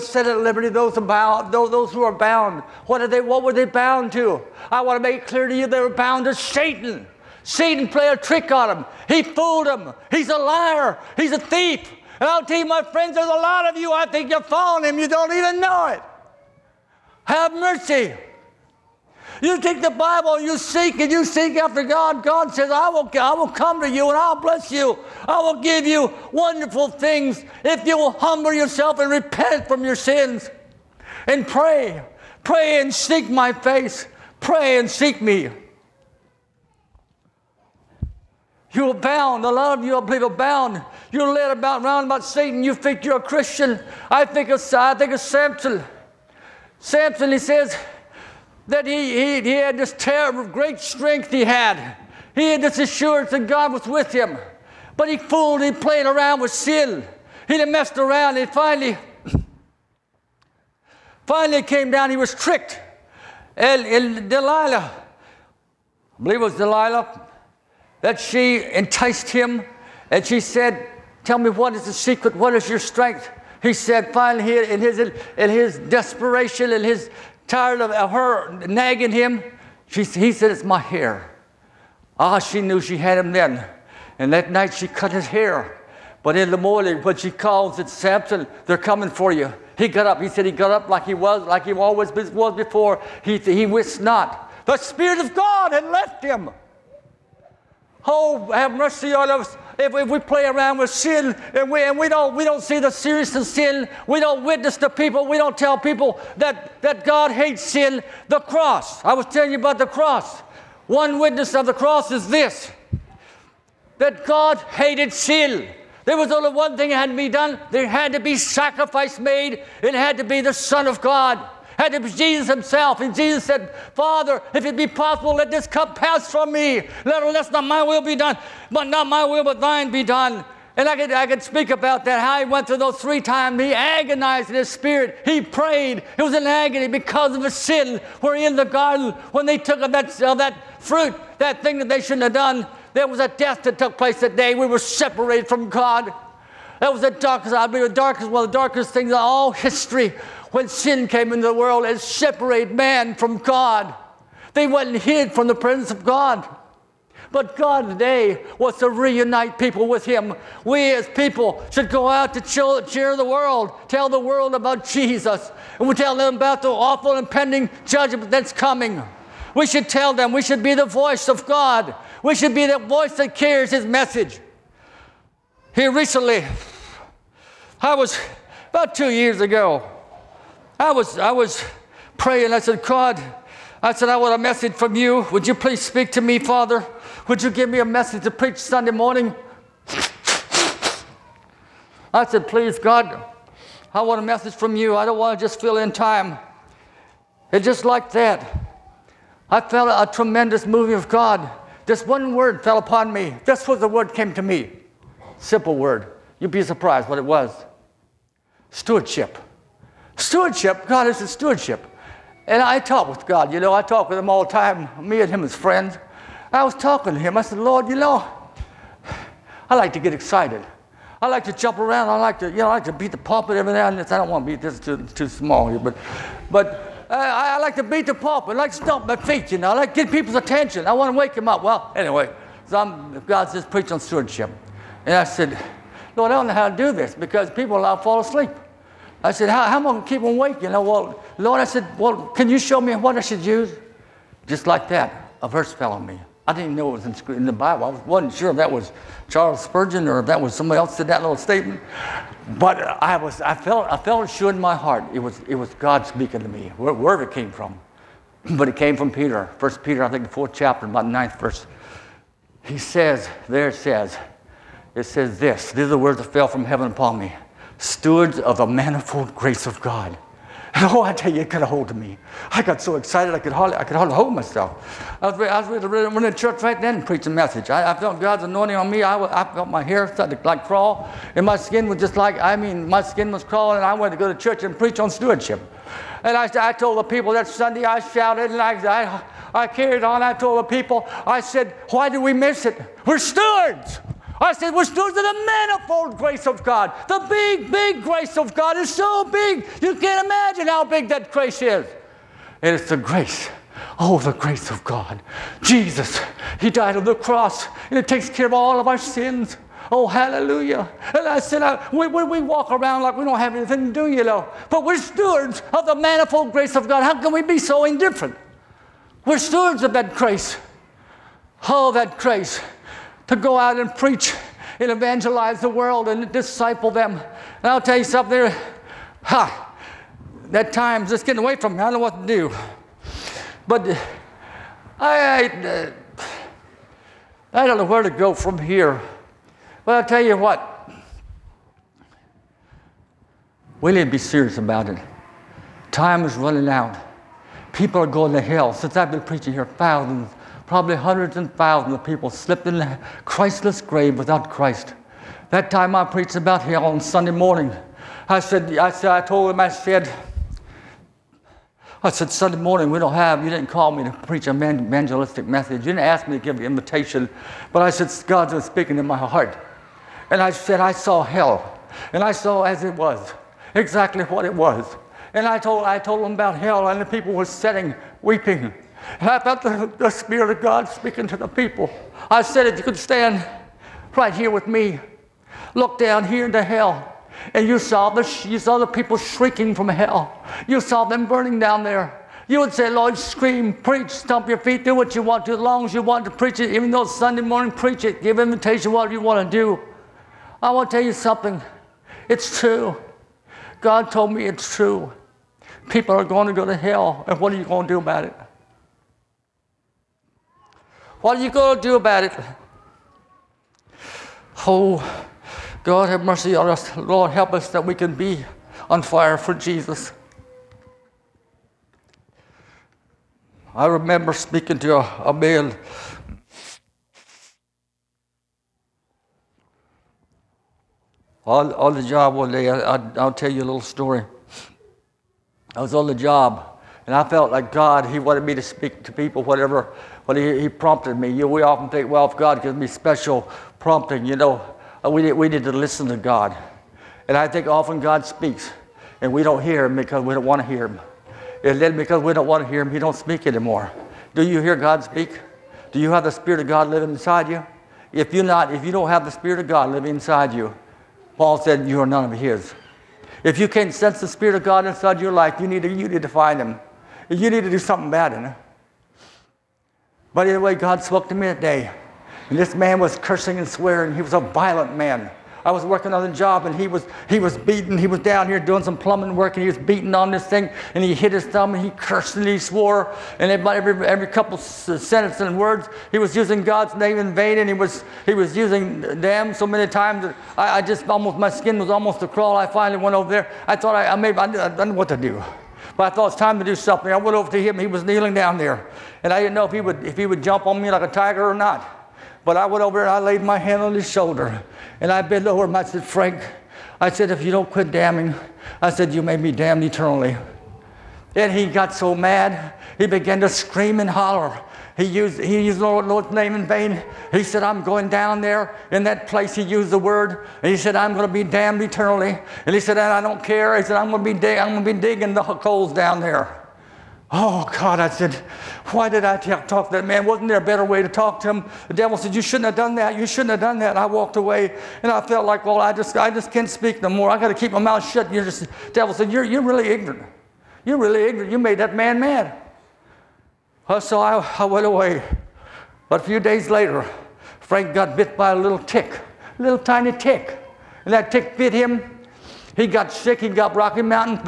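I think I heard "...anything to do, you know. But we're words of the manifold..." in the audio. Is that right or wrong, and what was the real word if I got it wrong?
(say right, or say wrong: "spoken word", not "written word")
wrong: "stewards", not "words".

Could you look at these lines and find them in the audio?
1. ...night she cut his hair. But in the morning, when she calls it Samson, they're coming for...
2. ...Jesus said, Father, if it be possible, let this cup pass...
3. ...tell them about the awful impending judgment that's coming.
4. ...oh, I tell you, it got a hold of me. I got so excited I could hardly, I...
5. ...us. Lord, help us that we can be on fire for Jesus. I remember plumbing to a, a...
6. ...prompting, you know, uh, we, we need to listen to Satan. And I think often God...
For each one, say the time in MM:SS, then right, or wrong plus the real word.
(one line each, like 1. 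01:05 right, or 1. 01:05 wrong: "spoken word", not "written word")
1. 01:24 right
2. 02:03 right
3. 02:45 right
4. 04:30 right
5. 06:56 wrong: "speaking", not "plumbing"
6. 07:23 wrong: "God", not "Satan".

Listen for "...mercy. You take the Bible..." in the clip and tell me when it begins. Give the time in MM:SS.
00:17.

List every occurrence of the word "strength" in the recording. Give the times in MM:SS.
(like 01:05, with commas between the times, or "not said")
00:50, 01:12.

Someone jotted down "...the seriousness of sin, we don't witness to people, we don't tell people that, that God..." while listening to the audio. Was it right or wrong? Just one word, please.
right.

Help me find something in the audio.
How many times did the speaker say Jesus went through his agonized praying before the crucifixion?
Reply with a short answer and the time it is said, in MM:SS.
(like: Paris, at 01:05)
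3, at 02:13.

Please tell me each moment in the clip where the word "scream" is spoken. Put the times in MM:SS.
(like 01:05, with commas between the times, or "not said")
06:33, 08:33.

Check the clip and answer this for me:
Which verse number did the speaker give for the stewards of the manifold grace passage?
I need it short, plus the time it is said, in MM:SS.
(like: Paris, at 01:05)
9, at 04:21.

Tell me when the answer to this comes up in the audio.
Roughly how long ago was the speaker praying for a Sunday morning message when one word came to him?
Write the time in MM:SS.
02:58.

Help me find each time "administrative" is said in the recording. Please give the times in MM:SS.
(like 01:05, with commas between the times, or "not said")
not said.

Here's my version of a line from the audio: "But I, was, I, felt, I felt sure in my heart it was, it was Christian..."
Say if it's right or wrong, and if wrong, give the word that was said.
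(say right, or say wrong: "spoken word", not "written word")
wrong: "God", not "Christian".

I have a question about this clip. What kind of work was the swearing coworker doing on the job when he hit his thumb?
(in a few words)
Plumbing.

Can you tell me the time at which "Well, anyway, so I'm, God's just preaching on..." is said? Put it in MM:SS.
03:51.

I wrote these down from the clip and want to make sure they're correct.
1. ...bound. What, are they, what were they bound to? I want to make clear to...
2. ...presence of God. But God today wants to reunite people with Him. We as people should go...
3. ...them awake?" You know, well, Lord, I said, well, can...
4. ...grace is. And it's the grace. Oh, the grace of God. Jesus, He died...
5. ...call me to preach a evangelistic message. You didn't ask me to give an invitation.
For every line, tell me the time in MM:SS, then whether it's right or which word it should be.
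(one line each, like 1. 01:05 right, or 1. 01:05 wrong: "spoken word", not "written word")
1. 00:02 right
2. 02:35 right
3. 04:00 right
4. 05:01 right
5. 06:03 right.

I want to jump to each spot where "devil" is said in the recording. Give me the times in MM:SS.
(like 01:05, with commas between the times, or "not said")
08:51, 08:58.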